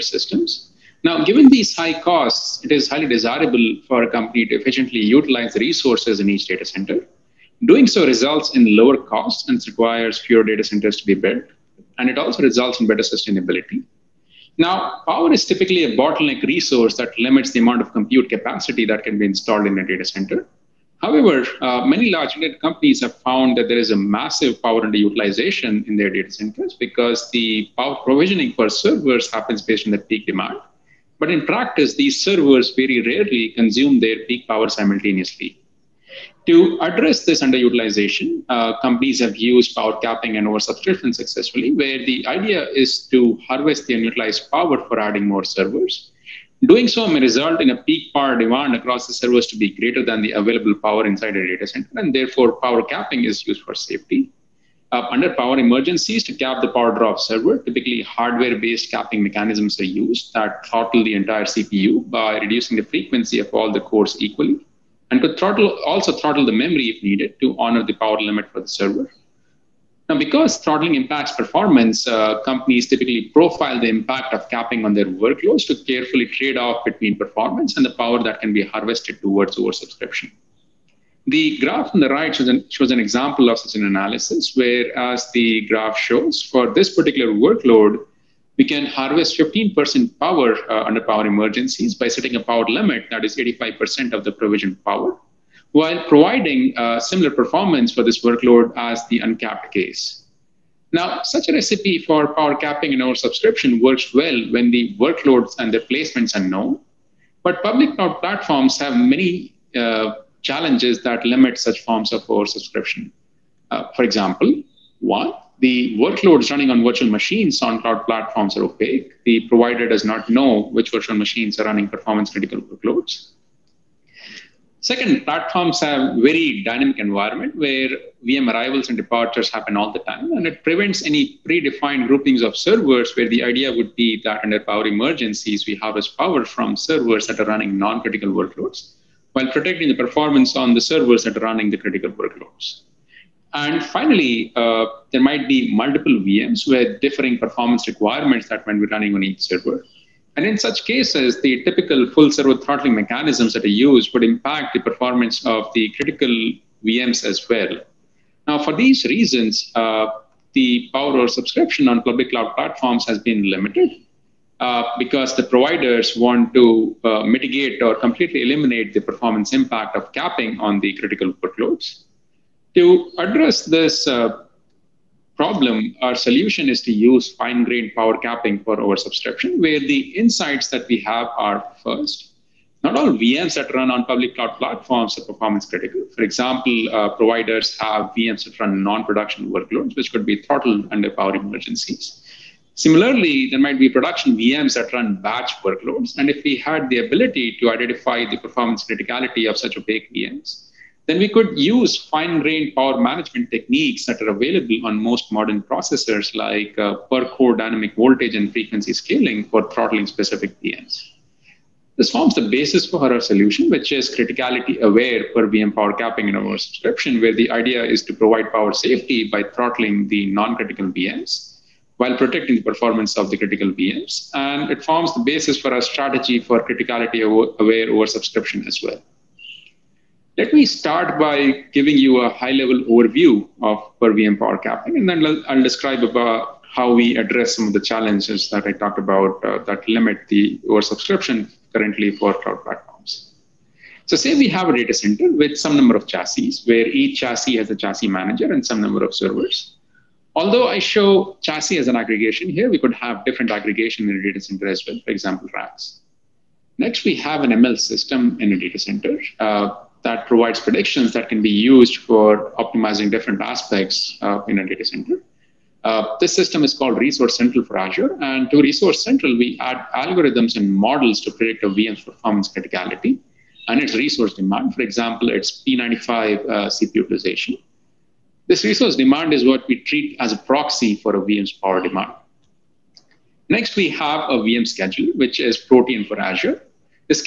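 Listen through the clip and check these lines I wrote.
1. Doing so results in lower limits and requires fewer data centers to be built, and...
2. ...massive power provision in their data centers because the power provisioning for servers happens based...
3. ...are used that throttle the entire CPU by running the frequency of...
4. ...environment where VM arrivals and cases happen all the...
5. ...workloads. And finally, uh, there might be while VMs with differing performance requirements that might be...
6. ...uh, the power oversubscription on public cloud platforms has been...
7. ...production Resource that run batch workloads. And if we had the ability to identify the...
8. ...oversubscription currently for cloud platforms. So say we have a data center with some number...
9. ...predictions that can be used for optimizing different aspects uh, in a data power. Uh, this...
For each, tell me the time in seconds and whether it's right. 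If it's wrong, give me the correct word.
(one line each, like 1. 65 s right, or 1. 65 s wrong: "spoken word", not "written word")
1. 7 s wrong: "costs", not "limits"
2. 23 s wrong: "underutilization", not "provision"
3. 59 s wrong: "reducing", not "running"
4. 126 s wrong: "departures", not "cases"
5. 142 s wrong: "multiple", not "while"
6. 159 s right
7. 193 s wrong: "VMs", not "Resource"
8. 240 s right
9. 260 s wrong: "center", not "power".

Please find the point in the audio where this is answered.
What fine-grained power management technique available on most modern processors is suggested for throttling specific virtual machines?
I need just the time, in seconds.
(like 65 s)
207 s.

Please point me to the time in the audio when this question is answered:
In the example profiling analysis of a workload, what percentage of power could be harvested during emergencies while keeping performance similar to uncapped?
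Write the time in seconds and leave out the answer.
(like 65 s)
89 s.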